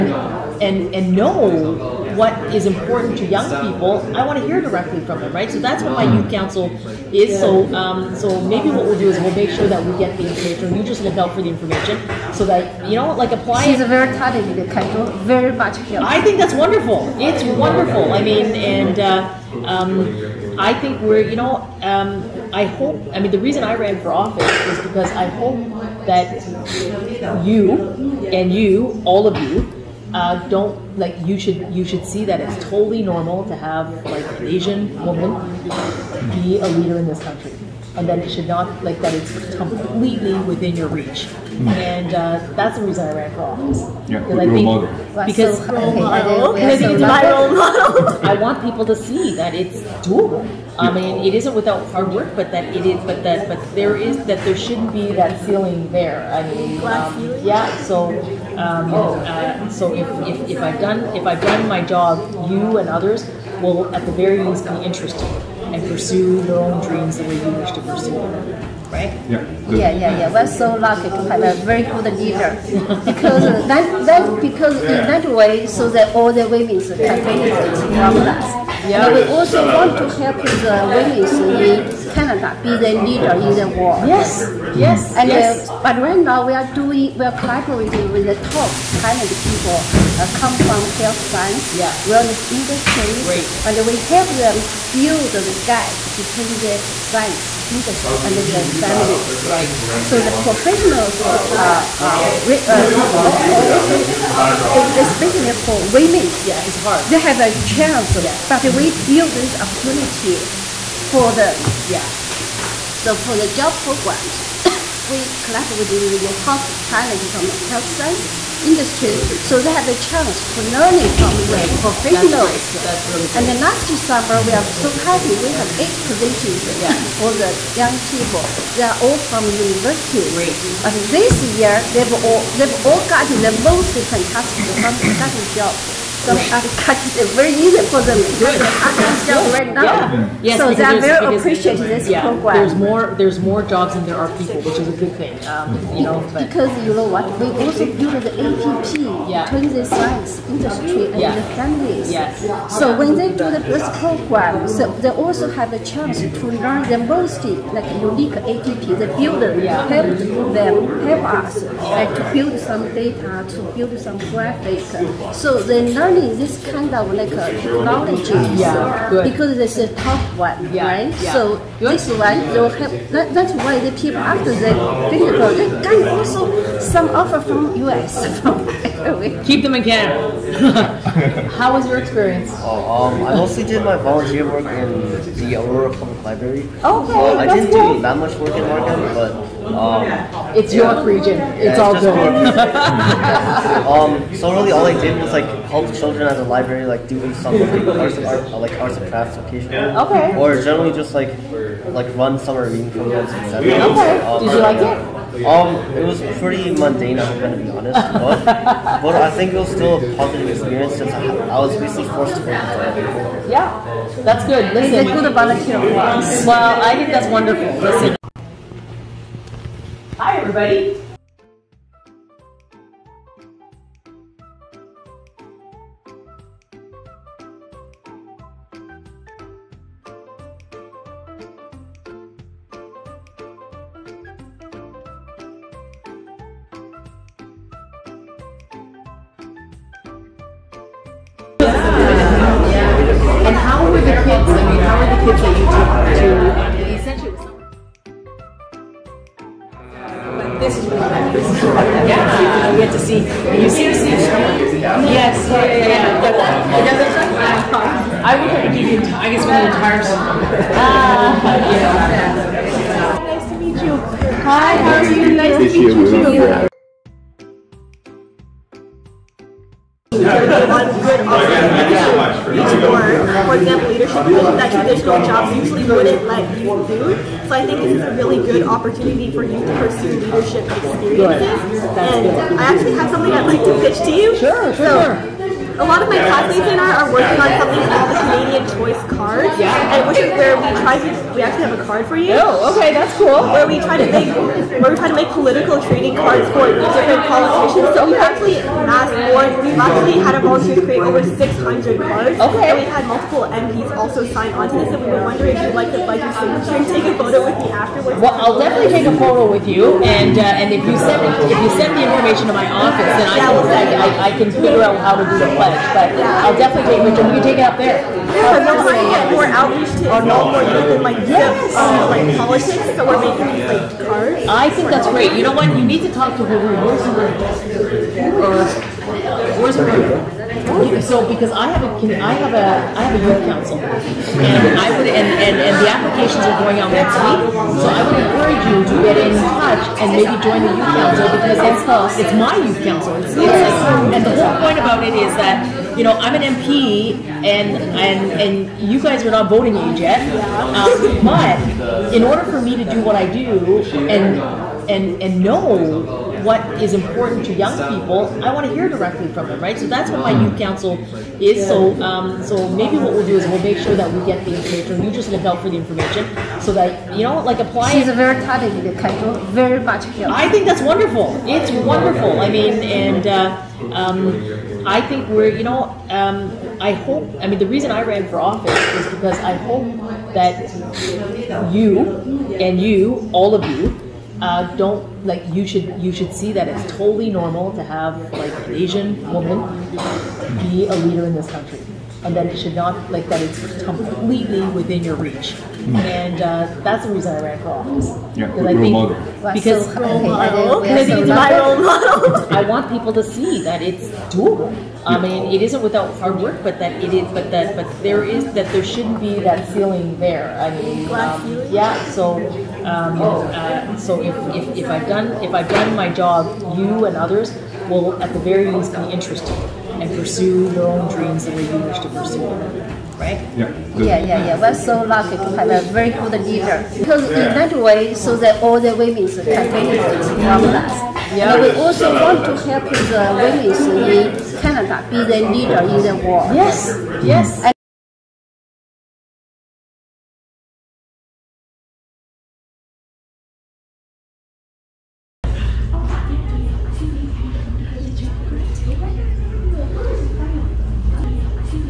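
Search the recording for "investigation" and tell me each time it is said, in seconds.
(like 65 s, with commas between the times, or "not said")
not said.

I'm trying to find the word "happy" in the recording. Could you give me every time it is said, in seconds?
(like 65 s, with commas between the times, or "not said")
124 s.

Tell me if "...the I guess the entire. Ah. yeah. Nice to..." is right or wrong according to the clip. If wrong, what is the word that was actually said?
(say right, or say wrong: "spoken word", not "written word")
right.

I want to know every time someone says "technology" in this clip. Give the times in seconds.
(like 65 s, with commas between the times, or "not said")
167 s.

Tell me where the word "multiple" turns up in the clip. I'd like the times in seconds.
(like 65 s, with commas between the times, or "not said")
303 s.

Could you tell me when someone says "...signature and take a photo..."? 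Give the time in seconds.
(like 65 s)
306 s.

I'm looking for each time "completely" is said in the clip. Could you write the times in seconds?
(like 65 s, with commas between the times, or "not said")
39 s, 393 s.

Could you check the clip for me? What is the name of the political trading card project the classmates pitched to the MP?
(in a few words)
Canadian Choice Card.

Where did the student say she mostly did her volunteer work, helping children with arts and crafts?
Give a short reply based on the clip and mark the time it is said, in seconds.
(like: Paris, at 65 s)
Aurora Public Library, at 185 s.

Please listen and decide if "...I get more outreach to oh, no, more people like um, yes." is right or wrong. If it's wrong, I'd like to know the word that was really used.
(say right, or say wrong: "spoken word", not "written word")
right.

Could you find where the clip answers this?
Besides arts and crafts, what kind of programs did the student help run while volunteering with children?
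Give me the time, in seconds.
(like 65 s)
202 s.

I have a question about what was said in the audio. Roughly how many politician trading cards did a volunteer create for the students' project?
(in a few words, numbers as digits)
over 600.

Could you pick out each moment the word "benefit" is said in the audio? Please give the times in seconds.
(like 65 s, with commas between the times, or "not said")
76 s, 429 s.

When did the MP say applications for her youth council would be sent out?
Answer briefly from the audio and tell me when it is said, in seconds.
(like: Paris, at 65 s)
next week, at 336 s.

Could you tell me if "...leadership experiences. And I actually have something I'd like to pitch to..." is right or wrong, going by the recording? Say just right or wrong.
right.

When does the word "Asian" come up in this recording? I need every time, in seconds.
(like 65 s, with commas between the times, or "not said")
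34 s, 388 s.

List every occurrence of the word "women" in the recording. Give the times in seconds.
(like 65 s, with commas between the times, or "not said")
76 s, 80 s, 105 s, 428 s, 433 s.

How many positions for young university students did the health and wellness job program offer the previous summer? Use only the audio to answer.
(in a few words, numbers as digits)
8.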